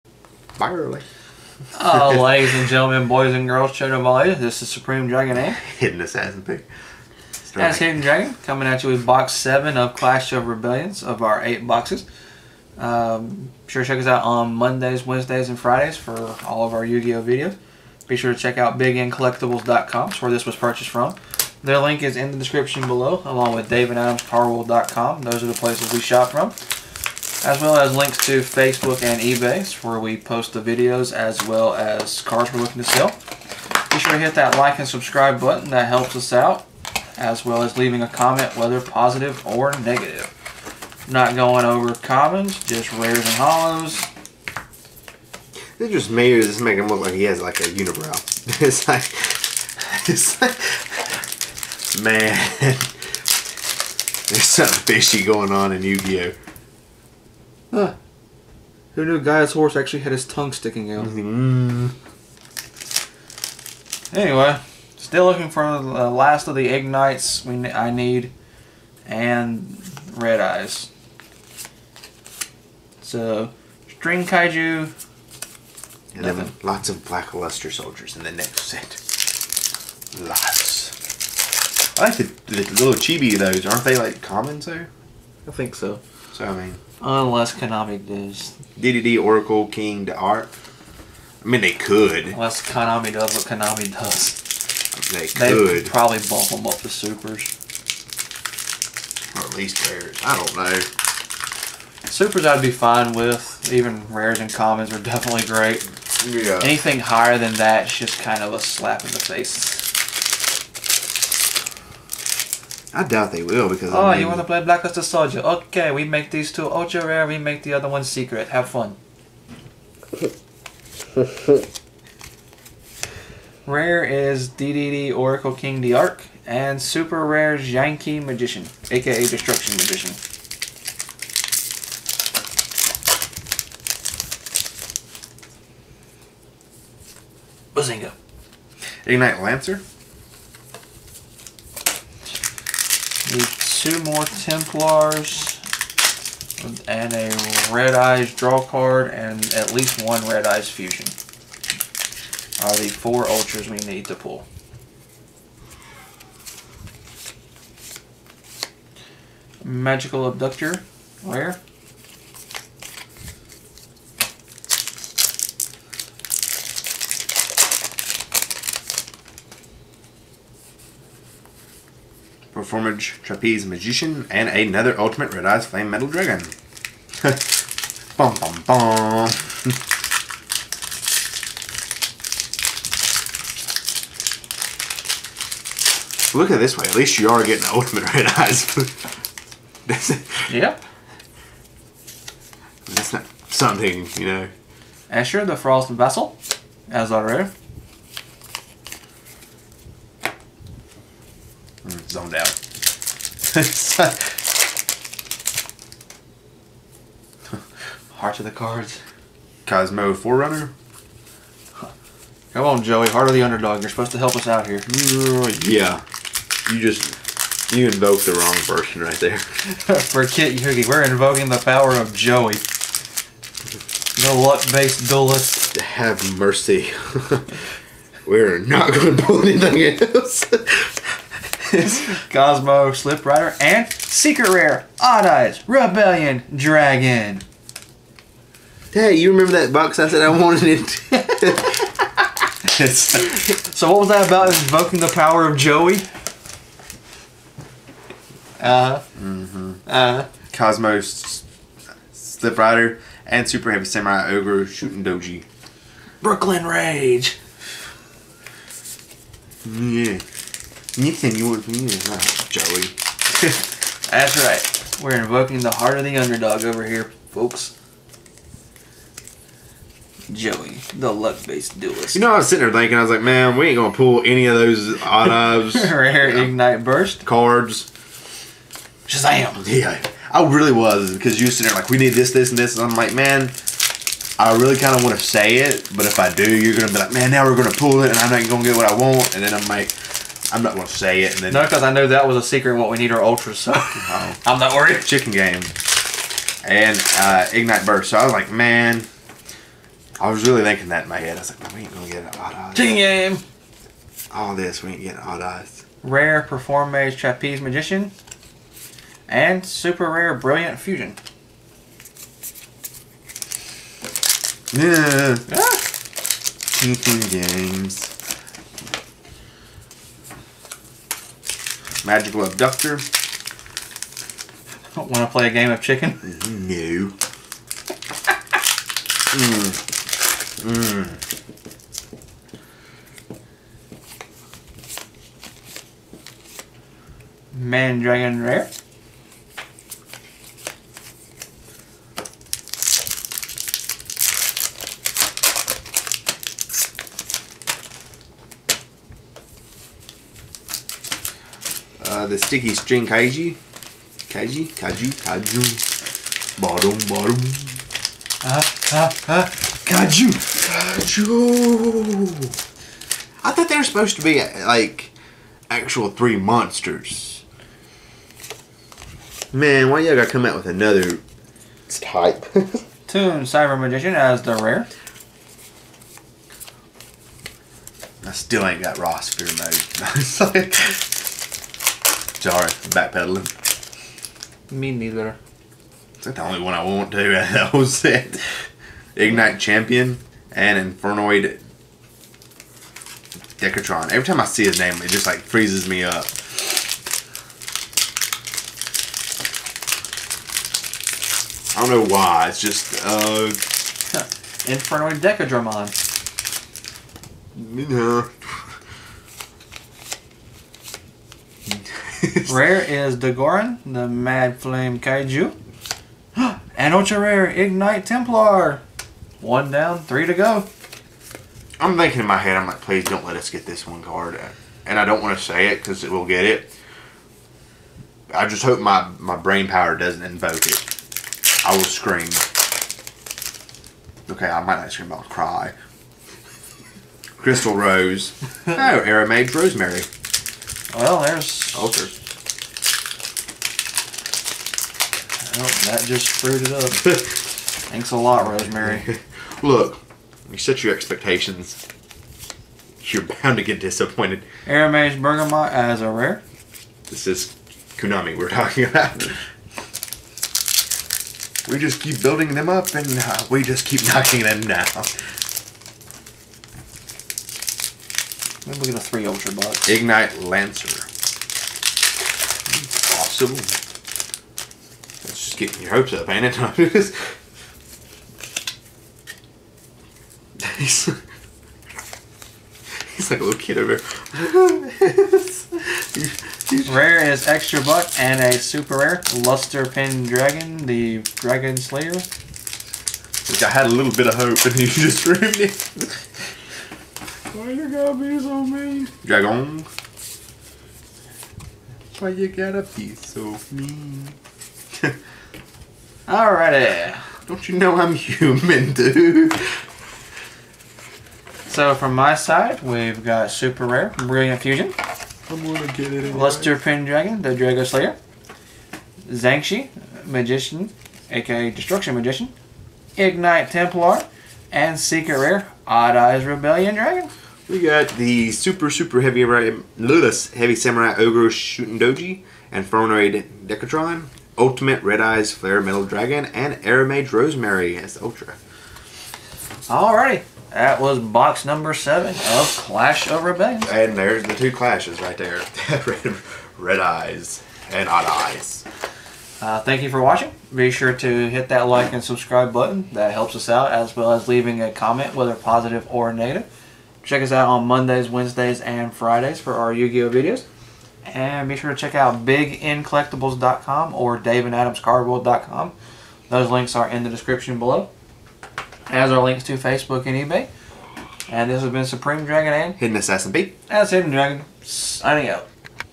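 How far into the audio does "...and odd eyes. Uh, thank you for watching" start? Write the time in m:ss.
9:07.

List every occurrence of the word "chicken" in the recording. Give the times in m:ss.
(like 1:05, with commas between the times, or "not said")
4:55, 5:02, 5:16, 5:25.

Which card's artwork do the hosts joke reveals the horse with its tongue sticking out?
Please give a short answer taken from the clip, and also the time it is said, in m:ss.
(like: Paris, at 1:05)
Gaia, at 0:59.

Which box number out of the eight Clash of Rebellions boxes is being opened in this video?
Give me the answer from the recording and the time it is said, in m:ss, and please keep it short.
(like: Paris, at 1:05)
7, at 0:09.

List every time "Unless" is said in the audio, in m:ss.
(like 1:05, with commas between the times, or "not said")
1:27, 1:32.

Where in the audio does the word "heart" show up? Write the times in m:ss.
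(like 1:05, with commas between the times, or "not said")
3:28, 3:33, 4:25.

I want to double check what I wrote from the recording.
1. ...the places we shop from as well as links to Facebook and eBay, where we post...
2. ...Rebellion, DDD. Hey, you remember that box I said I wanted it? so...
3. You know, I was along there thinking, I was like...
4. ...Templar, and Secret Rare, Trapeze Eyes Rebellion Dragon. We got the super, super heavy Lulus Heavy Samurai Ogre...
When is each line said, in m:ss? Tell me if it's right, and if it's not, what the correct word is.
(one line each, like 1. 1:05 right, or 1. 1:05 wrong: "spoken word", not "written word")
1. 0:25 right
2. 3:55 wrong: "Dragon", not "DDD"
3. 4:32 wrong: "sitting", not "along"
4. 8:43 wrong: "Odd", not "Trapeze".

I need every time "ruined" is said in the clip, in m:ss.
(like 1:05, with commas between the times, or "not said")
8:15.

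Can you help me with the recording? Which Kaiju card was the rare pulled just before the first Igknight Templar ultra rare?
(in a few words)
Dogoran, the Mad Flame Kaiju.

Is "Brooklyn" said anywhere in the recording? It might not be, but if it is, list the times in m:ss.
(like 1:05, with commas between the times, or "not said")
4:16.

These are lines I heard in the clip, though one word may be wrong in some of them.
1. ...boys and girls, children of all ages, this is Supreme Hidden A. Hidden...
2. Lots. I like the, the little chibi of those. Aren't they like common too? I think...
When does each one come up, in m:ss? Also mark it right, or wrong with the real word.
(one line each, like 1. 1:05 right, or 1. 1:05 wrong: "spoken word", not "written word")
1. 0:03 wrong: "Dragon", not "Hidden"
2. 1:20 right.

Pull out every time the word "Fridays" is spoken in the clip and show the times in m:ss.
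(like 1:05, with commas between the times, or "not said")
0:15, 9:19.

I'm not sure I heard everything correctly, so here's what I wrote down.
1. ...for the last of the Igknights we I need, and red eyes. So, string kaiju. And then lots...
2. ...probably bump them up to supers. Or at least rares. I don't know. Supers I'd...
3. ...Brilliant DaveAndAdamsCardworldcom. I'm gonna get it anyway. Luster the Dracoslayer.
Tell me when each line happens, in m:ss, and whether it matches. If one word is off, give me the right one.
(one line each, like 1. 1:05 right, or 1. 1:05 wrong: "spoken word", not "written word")
1. 1:05 right
2. 1:35 right
3. 8:34 wrong: "Fusion", not "DaveAndAdamsCardworldcom".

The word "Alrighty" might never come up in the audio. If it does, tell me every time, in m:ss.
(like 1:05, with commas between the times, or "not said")
8:26, 8:59.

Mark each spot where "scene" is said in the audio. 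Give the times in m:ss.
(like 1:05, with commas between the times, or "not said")
not said.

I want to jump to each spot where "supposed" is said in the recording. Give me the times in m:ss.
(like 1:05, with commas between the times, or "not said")
3:33, 6:03.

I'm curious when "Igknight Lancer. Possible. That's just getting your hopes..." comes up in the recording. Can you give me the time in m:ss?
7:49.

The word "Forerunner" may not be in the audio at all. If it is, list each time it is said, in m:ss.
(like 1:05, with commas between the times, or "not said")
3:30.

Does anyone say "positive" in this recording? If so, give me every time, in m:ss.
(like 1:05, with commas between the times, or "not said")
0:38, 9:15.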